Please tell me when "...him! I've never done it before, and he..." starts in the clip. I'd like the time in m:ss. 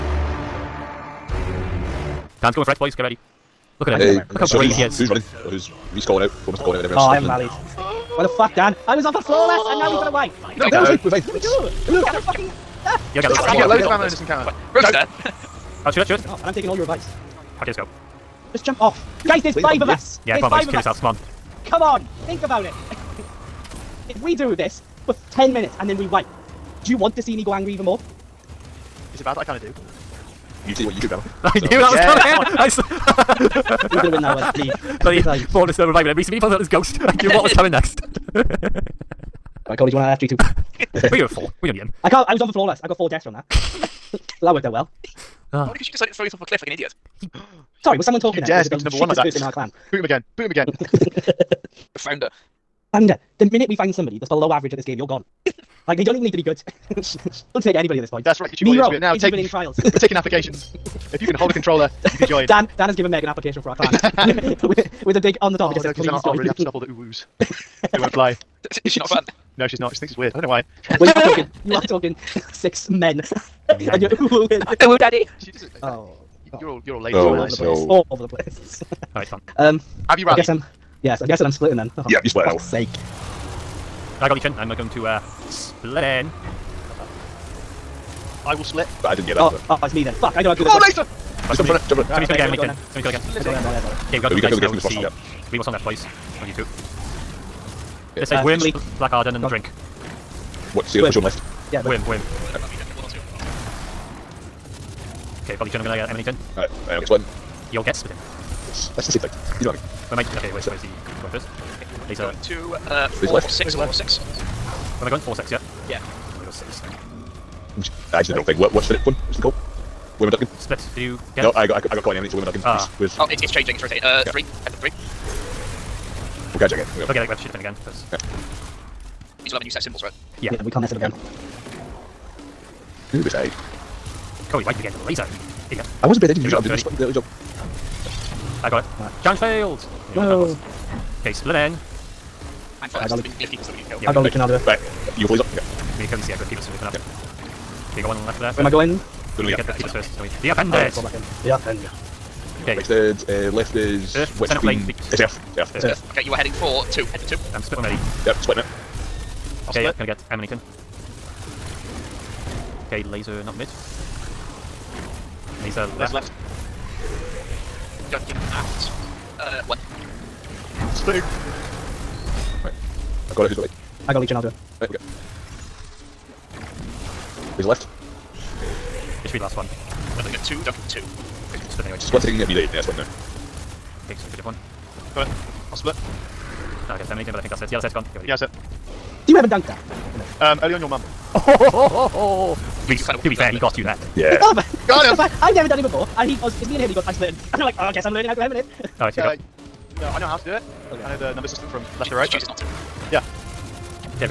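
3:15.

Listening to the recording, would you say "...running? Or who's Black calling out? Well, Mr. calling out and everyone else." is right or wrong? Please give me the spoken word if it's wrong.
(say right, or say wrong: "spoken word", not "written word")
wrong: "Reese", not "Black".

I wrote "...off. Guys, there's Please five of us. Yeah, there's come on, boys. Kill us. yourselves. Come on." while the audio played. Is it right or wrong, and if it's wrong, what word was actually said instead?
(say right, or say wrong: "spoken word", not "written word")
right.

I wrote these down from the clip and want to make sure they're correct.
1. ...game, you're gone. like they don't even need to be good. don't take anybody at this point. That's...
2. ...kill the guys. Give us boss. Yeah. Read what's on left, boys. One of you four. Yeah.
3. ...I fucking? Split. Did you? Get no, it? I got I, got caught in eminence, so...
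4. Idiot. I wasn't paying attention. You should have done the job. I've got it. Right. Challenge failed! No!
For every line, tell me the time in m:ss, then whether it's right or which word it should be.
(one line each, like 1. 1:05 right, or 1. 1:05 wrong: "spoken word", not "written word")
1. 0:54 right
2. 1:34 wrong: "two", not "four"
3. 2:00 wrong: "ducking", not "fucking"
4. 2:15 right.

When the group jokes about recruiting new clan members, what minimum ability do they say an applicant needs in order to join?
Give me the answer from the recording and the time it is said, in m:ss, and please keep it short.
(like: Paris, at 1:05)
Hold a controller, at 1:01.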